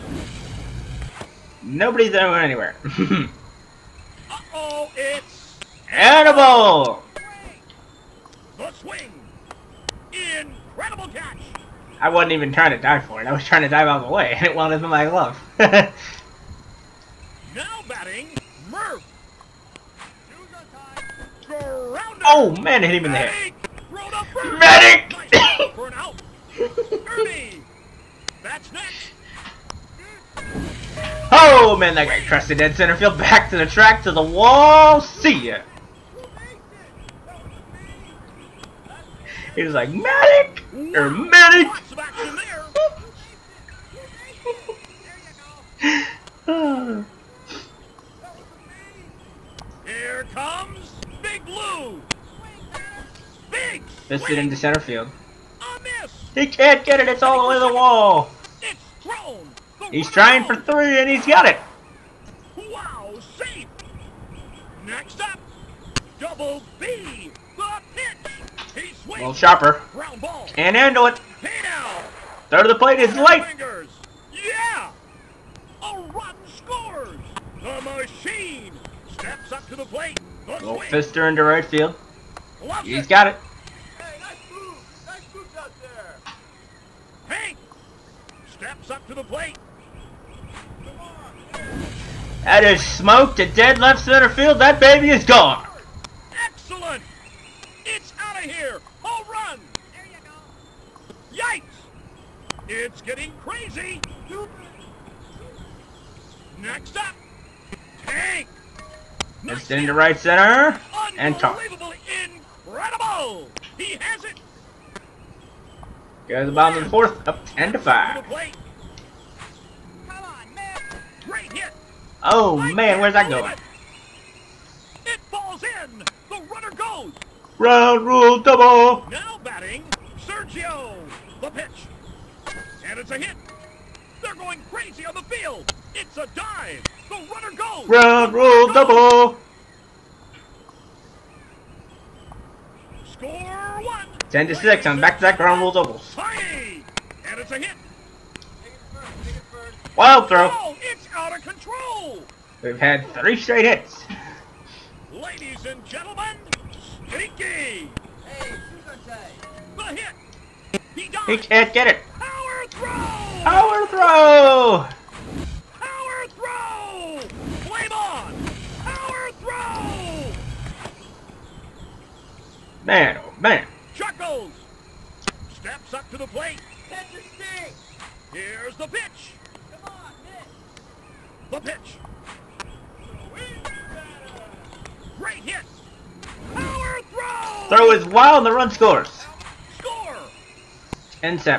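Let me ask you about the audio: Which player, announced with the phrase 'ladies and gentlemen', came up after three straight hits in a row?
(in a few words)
Stinky.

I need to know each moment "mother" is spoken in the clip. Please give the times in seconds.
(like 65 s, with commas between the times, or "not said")
not said.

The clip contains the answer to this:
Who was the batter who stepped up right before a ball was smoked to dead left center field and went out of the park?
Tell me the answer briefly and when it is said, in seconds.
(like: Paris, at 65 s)
Hank, at 87 s.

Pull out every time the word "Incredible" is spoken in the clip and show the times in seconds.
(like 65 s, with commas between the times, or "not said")
112 s.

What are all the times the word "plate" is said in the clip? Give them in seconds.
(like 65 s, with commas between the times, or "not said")
72 s, 79 s, 89 s, 176 s.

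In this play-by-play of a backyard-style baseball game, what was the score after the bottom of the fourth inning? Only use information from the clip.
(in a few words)
10 to 5.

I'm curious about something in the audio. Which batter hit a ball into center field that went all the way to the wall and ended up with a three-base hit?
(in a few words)
Big Blue.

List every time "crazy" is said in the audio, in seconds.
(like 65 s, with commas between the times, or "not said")
103 s, 134 s.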